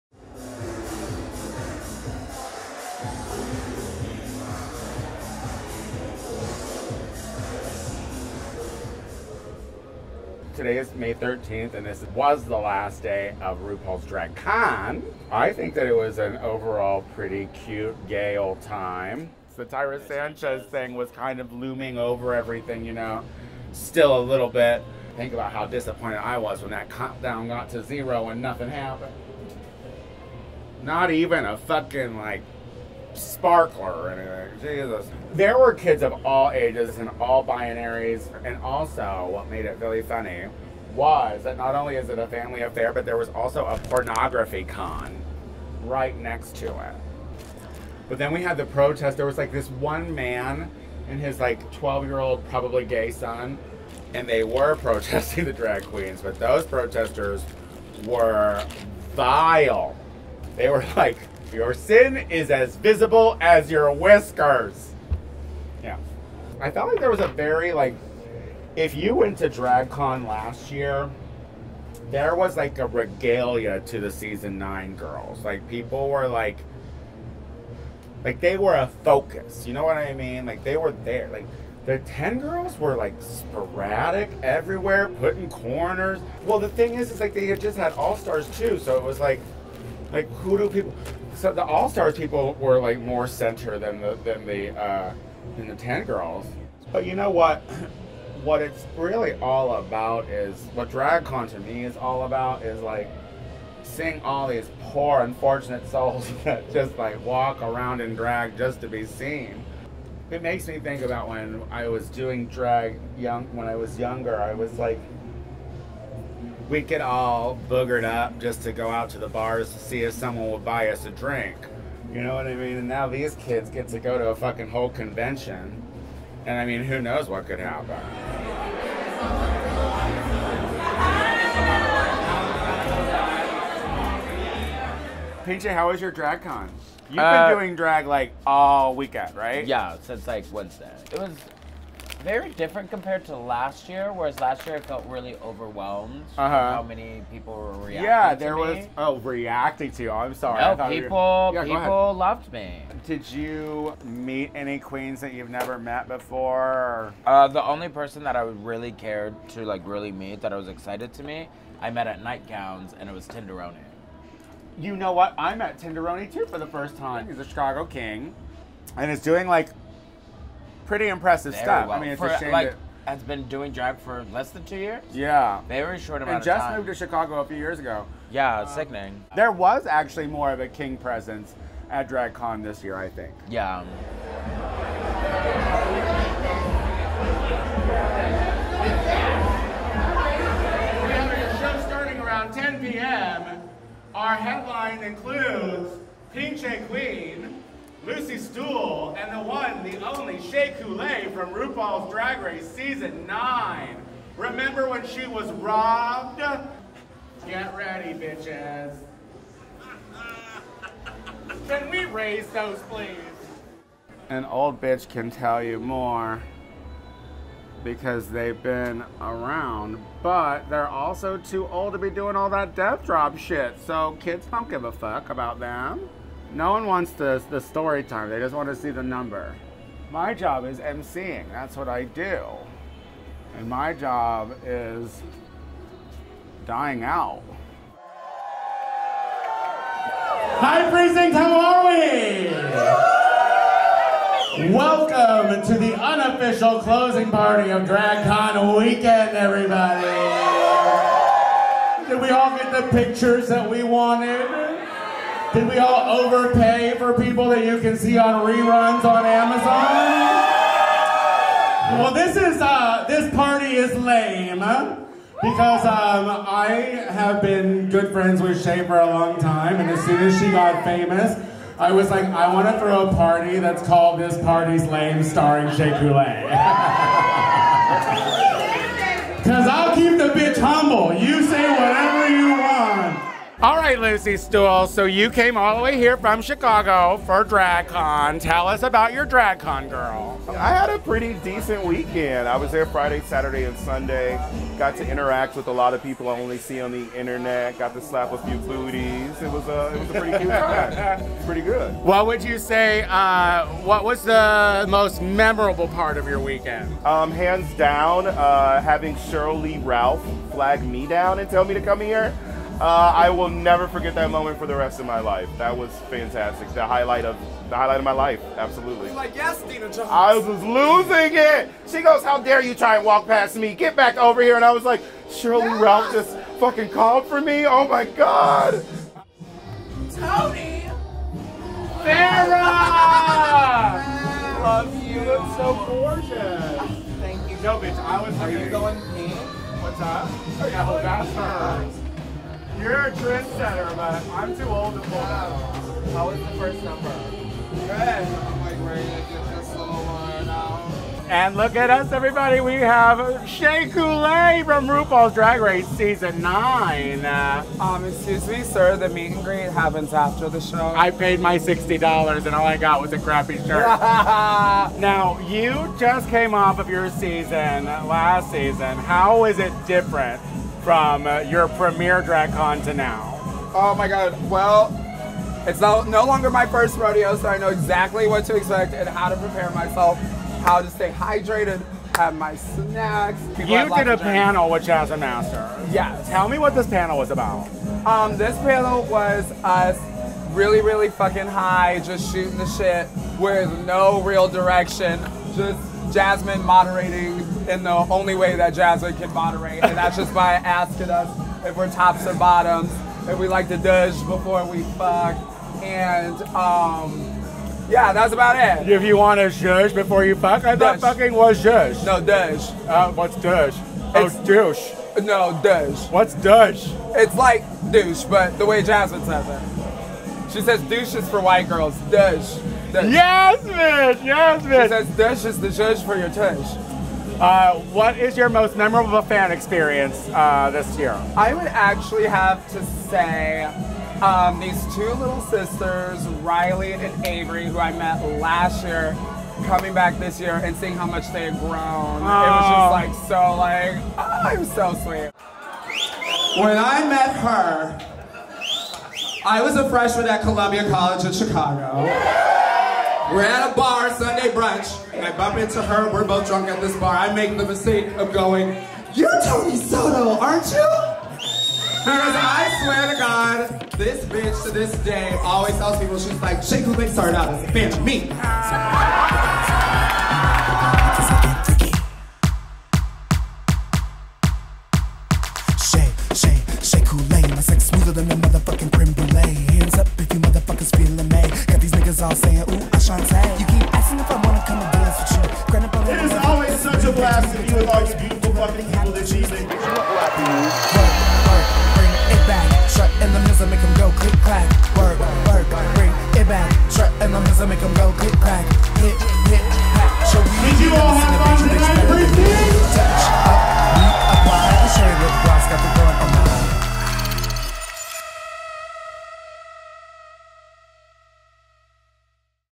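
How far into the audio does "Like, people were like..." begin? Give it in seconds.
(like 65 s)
75 s.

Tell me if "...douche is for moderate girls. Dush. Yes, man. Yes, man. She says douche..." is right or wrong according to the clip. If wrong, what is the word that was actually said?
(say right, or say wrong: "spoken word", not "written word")
wrong: "white", not "moderate".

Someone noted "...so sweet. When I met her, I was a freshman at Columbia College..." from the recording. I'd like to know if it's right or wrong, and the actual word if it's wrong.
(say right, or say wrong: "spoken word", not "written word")
right.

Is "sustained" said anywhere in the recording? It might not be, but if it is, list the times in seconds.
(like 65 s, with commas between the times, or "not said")
not said.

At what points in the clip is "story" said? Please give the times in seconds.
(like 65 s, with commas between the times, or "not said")
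227 s.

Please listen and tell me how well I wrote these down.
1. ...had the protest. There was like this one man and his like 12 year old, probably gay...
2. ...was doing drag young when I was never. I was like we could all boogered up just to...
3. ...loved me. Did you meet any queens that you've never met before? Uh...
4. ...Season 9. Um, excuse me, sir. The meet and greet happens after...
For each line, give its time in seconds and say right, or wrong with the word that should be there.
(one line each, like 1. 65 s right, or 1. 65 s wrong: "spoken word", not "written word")
1. 48 s right
2. 111 s wrong: "younger", not "never"
3. 152 s right
4. 355 s right.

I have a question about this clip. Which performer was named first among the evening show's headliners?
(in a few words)
Pinche Queen.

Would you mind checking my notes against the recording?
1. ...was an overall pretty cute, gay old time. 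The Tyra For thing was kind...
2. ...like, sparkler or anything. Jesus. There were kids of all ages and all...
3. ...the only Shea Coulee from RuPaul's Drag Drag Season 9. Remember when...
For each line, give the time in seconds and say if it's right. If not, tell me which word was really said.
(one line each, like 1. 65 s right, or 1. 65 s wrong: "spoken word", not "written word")
1. 15 s wrong: "Sanchez", not "For"
2. 32 s right
3. 199 s wrong: "Race", not "Drag".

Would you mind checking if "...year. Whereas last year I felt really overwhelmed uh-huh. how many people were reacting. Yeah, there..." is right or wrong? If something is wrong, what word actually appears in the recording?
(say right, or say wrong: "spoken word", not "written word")
right.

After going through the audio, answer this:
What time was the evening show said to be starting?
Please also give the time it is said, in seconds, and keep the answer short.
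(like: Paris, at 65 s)
10 p.m., at 192 s.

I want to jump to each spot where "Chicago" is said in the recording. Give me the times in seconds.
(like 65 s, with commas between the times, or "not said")
167 s, 176 s, 286 s, 451 s.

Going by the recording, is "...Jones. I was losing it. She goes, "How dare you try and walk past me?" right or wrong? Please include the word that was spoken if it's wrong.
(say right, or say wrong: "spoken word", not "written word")
right.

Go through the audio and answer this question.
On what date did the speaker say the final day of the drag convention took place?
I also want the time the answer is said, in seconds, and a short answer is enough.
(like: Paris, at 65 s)
May 13th, at 10 s.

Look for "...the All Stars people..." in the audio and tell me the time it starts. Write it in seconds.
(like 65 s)
91 s.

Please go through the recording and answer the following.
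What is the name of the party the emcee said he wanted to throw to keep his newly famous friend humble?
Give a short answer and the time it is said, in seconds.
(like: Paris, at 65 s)
This Party's Lame, at 274 s.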